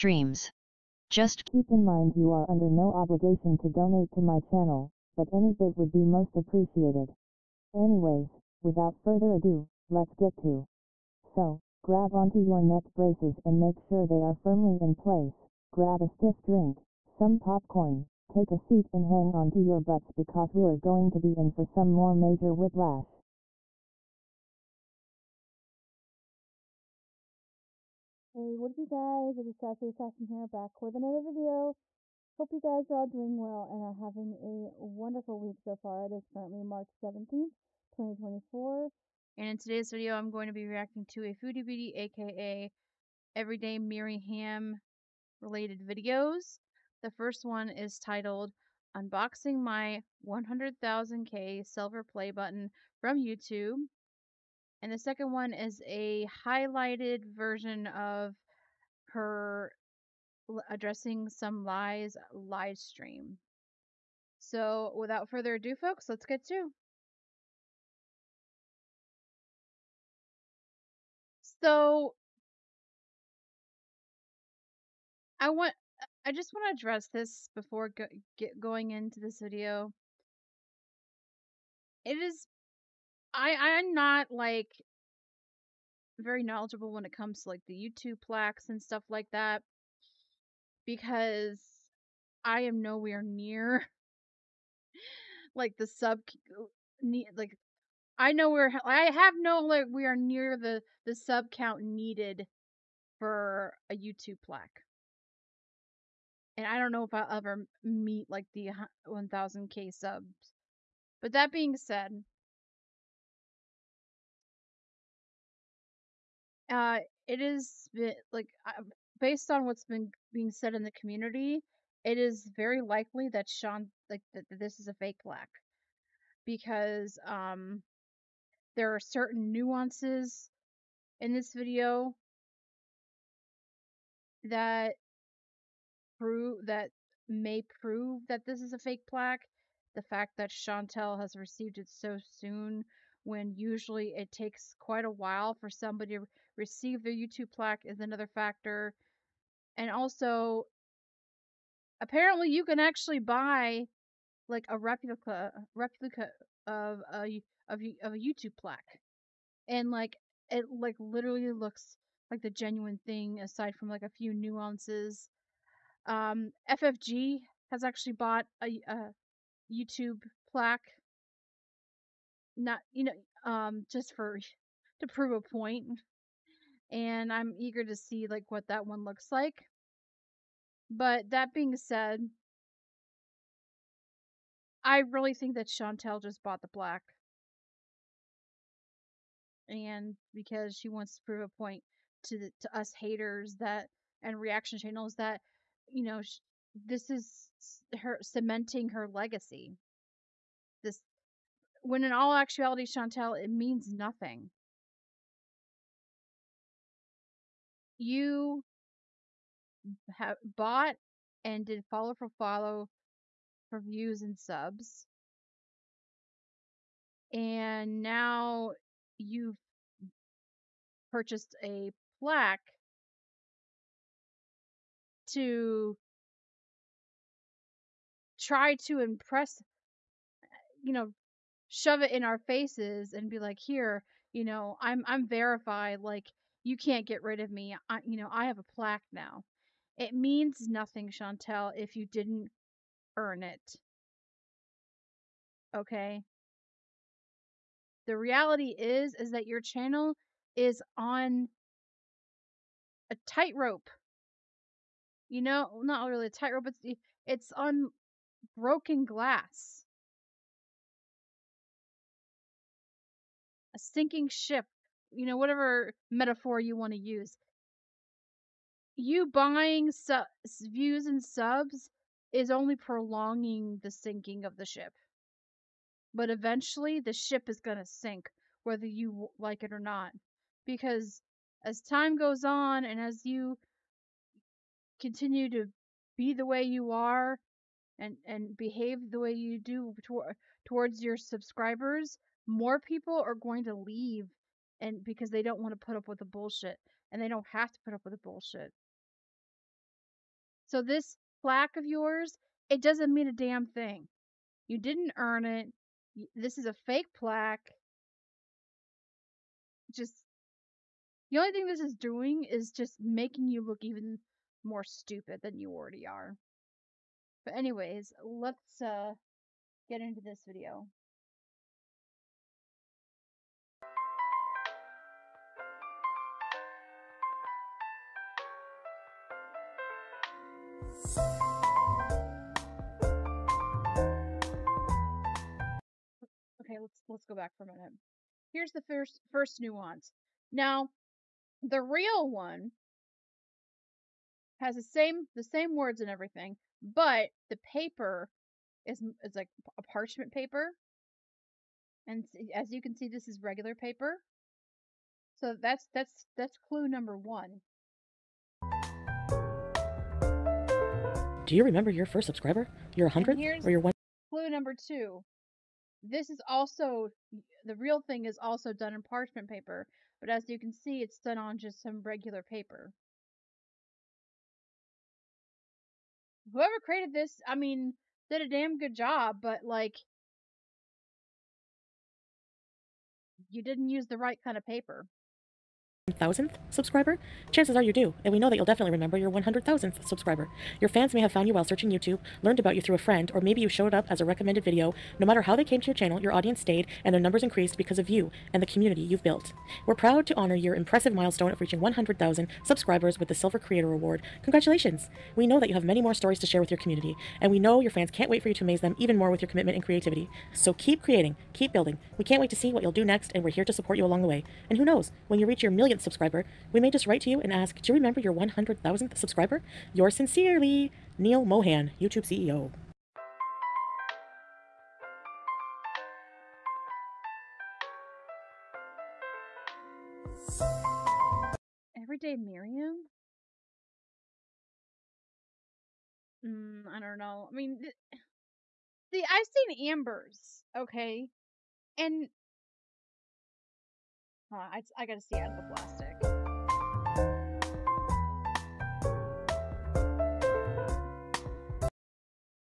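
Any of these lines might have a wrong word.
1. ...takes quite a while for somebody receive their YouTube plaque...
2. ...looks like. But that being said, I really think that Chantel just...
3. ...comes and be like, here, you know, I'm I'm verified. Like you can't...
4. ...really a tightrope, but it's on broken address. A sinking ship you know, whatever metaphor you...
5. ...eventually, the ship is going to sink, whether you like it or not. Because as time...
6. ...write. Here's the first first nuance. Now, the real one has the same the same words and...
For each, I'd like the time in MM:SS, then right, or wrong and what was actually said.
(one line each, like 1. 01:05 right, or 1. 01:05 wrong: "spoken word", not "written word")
1. 02:24 right
2. 02:59 right
3. 03:52 wrong: "faces", not "comes"
4. 04:16 wrong: "glass", not "address"
5. 04:36 right
6. 05:37 wrong: "minute", not "write".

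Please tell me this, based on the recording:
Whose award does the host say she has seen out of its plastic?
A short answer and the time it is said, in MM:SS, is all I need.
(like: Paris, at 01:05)
Amber, at 07:19.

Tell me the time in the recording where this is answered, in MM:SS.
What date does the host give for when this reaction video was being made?
00:36.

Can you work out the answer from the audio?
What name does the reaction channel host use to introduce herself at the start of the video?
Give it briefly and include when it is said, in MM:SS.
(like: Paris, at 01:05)
Sassy Assassin, at 00:29.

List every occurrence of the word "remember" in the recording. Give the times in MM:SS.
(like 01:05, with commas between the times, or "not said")
06:01, 06:28, 06:57.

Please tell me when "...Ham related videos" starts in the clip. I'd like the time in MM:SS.
00:44.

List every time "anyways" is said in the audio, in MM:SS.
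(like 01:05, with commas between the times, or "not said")
00:07, 05:17.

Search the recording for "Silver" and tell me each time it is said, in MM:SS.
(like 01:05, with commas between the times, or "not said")
00:51, 06:43.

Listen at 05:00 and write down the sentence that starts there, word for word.
So this plaque of yours, it doesn't mean a damn thing.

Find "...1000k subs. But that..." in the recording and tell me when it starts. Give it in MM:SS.
01:49.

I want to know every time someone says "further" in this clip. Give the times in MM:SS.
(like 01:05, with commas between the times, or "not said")
00:08, 01:05.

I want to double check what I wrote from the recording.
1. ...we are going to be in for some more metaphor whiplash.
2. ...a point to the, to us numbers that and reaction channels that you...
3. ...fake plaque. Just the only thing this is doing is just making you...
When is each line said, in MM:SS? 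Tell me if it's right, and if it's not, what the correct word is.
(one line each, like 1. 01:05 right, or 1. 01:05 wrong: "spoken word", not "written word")
1. 00:20 wrong: "major", not "metaphor"
2. 03:11 wrong: "haters", not "numbers"
3. 05:06 right.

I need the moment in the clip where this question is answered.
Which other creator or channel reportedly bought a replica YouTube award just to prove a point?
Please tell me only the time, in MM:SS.
02:46.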